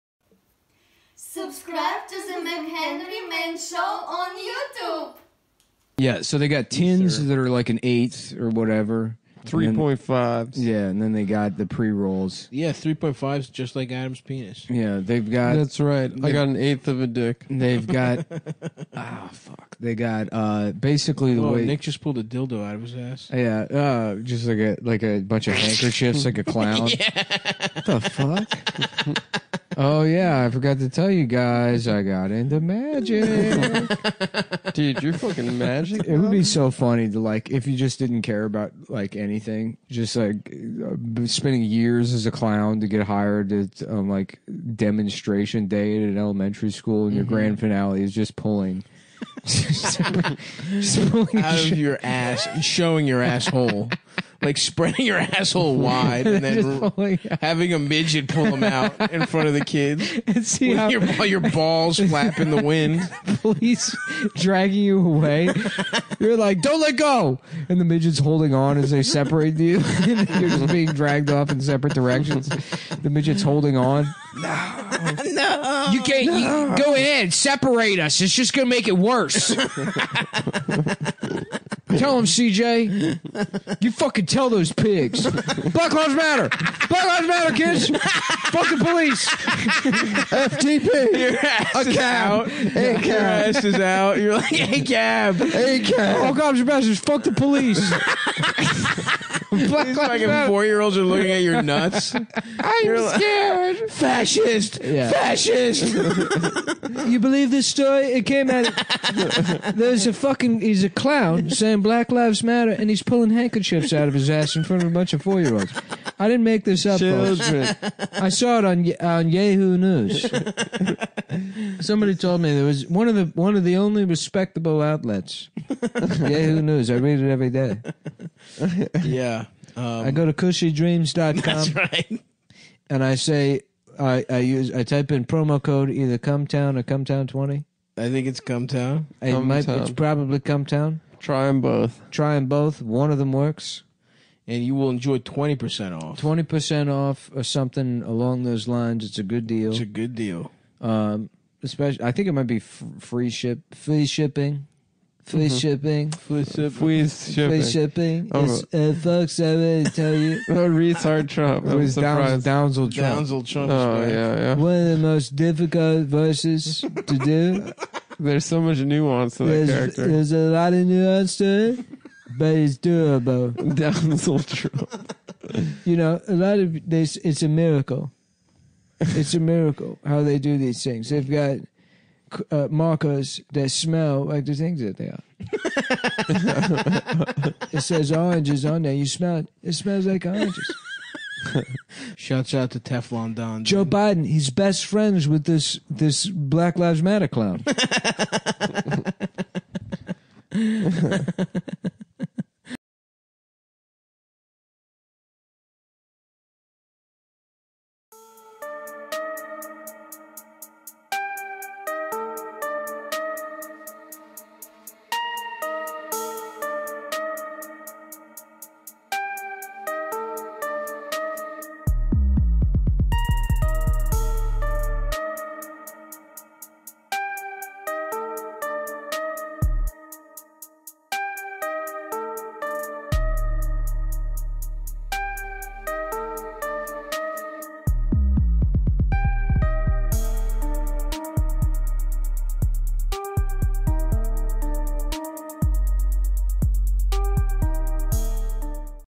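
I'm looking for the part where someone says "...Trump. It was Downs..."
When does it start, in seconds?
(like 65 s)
161 s.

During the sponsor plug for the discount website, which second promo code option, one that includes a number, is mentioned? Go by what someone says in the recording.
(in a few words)
Cumtown20.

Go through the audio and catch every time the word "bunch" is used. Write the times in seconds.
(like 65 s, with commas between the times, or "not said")
25 s, 114 s.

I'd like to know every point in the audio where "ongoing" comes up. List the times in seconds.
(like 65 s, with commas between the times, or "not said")
not said.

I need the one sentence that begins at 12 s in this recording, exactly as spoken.
Yeah, three point fives, just like Adam's penis.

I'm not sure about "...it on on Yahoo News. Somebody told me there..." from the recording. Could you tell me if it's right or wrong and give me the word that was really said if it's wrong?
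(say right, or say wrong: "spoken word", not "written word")
right.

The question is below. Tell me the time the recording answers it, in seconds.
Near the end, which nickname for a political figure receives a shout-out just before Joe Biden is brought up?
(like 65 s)
192 s.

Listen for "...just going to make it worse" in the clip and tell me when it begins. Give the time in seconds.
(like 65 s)
78 s.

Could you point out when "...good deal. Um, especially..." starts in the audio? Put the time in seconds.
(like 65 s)
149 s.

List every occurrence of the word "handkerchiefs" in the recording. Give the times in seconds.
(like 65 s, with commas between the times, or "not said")
25 s, 113 s.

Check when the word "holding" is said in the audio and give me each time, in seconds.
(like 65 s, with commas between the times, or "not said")
68 s, 73 s.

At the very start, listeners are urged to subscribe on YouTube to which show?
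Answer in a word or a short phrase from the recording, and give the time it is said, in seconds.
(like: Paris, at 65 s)
McHenry Man Show, at 2 s.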